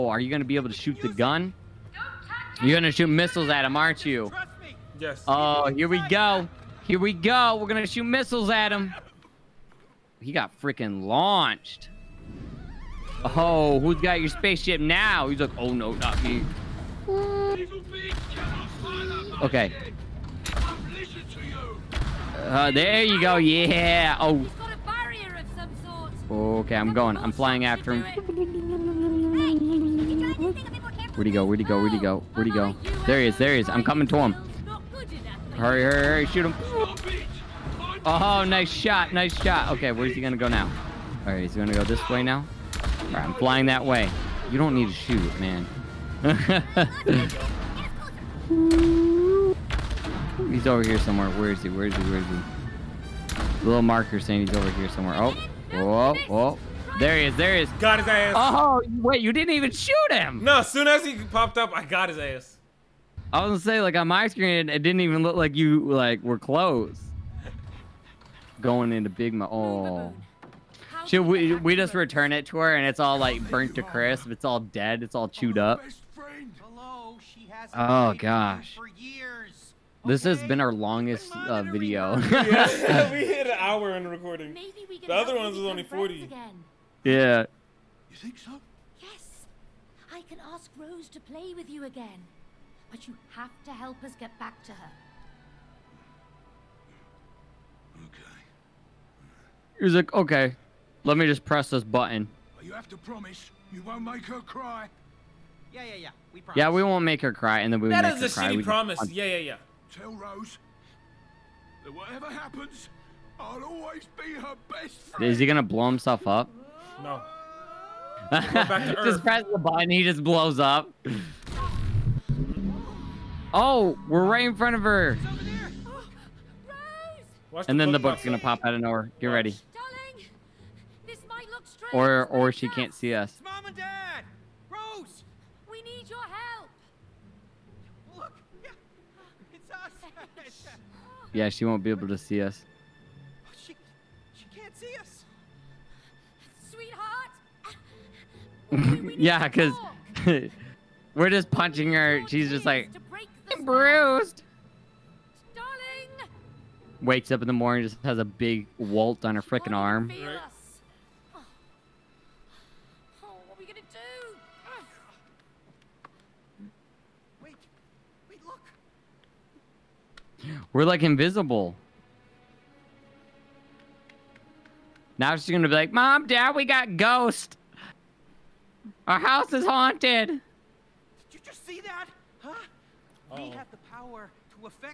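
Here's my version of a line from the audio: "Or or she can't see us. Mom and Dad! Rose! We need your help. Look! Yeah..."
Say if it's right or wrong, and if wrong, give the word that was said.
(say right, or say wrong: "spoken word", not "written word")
right.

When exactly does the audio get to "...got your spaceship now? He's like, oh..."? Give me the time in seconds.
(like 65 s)
13 s.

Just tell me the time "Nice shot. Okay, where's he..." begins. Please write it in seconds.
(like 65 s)
39 s.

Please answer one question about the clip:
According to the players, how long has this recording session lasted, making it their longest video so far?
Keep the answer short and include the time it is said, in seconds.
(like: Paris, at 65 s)
An hour, at 83 s.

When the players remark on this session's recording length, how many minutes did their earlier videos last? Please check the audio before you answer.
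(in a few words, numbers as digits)
40.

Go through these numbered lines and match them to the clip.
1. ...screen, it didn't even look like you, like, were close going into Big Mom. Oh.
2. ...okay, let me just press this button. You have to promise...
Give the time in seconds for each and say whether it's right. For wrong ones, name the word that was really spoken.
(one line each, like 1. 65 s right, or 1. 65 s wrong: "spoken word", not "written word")
1. 64 s right
2. 100 s right.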